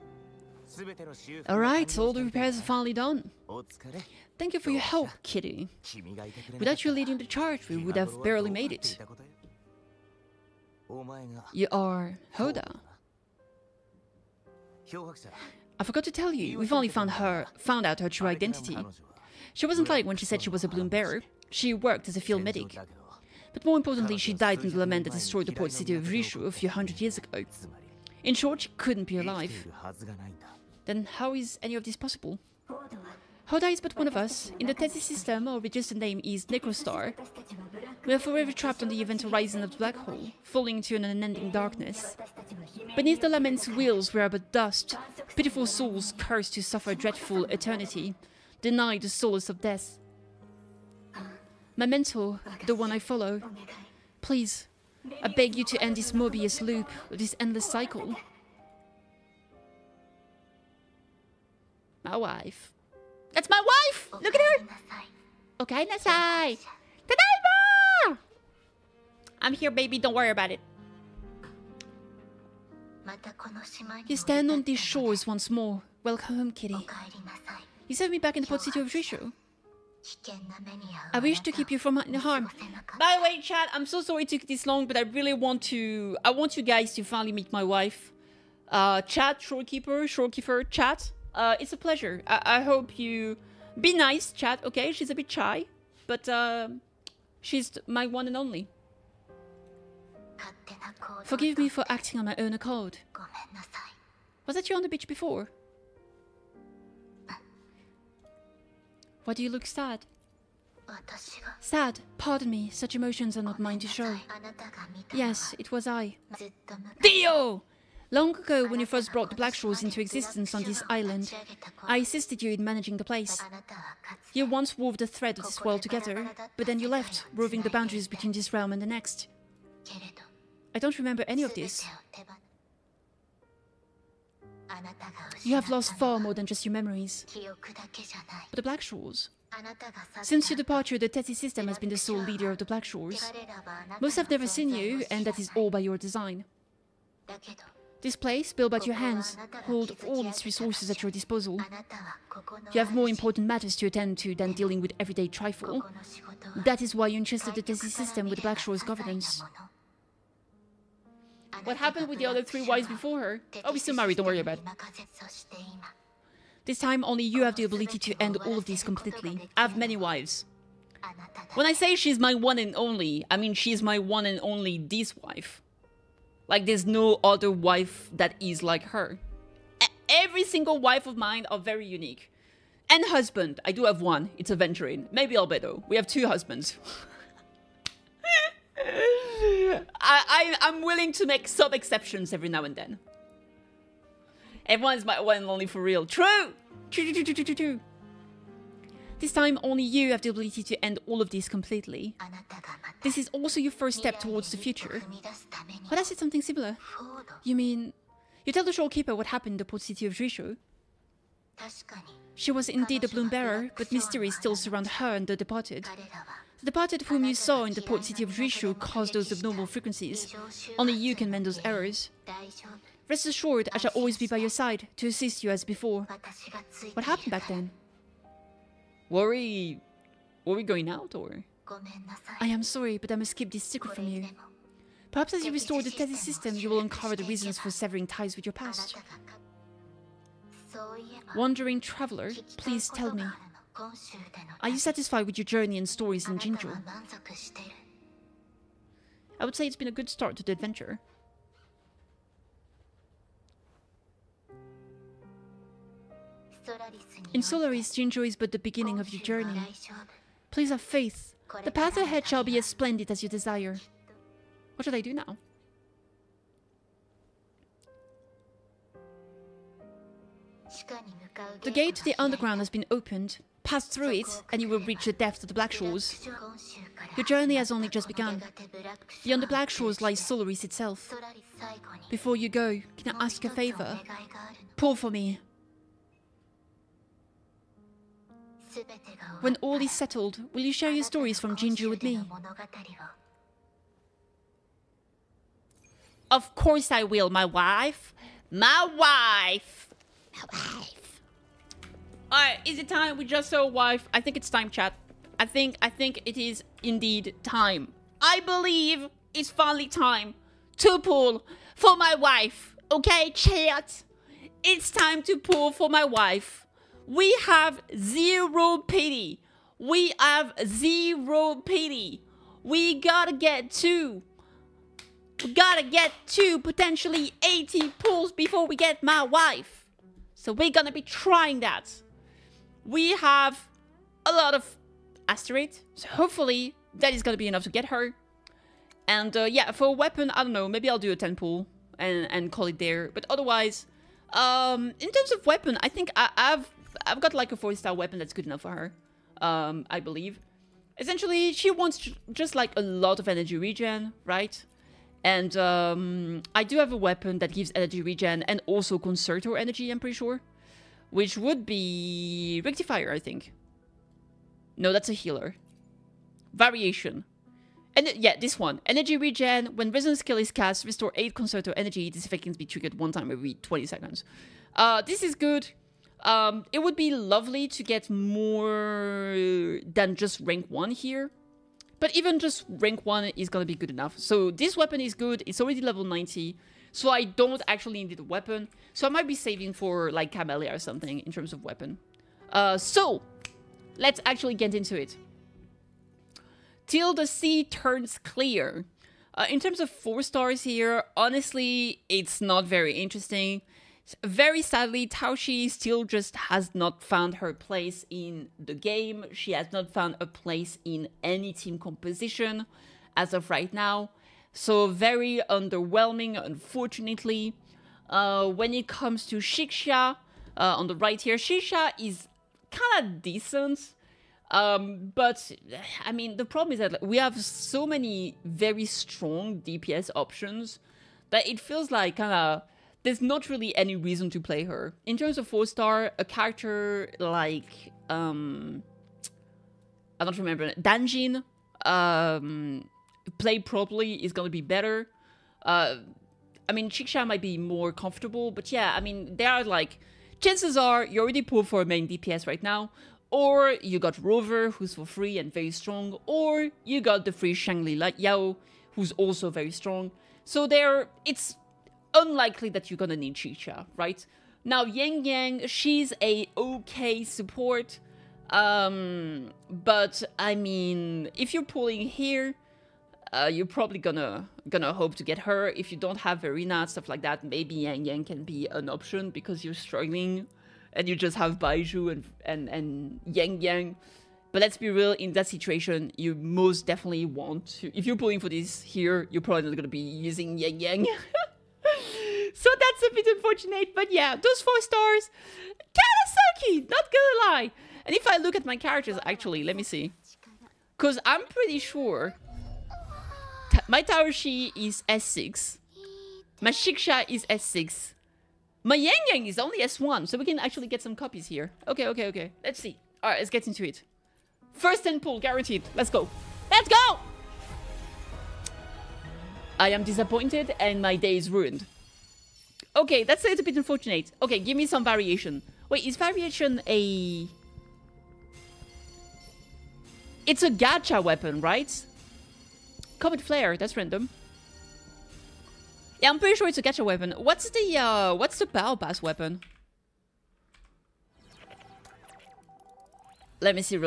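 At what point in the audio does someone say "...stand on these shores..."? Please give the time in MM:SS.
01:14.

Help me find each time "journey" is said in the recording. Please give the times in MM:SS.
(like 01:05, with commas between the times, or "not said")
04:05, 04:19, 04:37.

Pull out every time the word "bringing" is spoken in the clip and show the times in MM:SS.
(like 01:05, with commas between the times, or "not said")
not said.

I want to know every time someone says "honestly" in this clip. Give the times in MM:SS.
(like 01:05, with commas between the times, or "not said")
06:41.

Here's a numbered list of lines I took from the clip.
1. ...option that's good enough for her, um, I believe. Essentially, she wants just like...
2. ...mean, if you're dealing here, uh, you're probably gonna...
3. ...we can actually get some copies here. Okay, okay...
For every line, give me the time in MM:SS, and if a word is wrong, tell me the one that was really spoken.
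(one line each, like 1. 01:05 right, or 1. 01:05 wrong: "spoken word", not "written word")
1. 05:47 wrong: "weapon", not "option"
2. 07:50 wrong: "pulling", not "dealing"
3. 08:30 right.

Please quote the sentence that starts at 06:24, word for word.
So this weapon is good, it's already level 90.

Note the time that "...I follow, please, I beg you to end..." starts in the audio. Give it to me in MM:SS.
00:52.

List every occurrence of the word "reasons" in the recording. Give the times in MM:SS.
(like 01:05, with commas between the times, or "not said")
03:57, 07:13.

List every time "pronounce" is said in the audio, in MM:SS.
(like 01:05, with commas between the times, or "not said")
not said.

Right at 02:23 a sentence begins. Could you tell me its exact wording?
Most have never seen you, and that is all by your design.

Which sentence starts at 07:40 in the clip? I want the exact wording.
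So there it's unlikely that you're gonna need Chixia, right?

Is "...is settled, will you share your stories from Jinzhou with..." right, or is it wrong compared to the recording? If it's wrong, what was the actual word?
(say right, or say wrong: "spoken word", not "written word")
right.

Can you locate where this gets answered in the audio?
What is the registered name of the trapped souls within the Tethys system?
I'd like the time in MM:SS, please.
00:36.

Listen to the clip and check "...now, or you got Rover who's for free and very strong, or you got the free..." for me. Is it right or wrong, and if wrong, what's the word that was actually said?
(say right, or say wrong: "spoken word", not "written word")
right.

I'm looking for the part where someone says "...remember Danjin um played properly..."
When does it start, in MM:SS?
07:20.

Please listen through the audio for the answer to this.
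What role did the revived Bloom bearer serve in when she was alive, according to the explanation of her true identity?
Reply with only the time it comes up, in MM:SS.
00:22.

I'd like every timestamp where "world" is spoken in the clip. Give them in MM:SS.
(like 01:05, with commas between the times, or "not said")
02:05.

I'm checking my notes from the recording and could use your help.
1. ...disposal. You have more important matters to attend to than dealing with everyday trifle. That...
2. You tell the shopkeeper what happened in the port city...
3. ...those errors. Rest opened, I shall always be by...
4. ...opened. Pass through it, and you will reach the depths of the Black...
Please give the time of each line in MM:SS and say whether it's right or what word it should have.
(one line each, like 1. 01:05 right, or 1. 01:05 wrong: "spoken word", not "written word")
1. 02:31 right
2. 03:28 right
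3. 03:41 wrong: "assured", not "opened"
4. 04:32 right.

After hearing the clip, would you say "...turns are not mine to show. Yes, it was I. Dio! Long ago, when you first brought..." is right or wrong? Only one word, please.
wrong.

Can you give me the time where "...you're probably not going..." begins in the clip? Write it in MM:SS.
08:09.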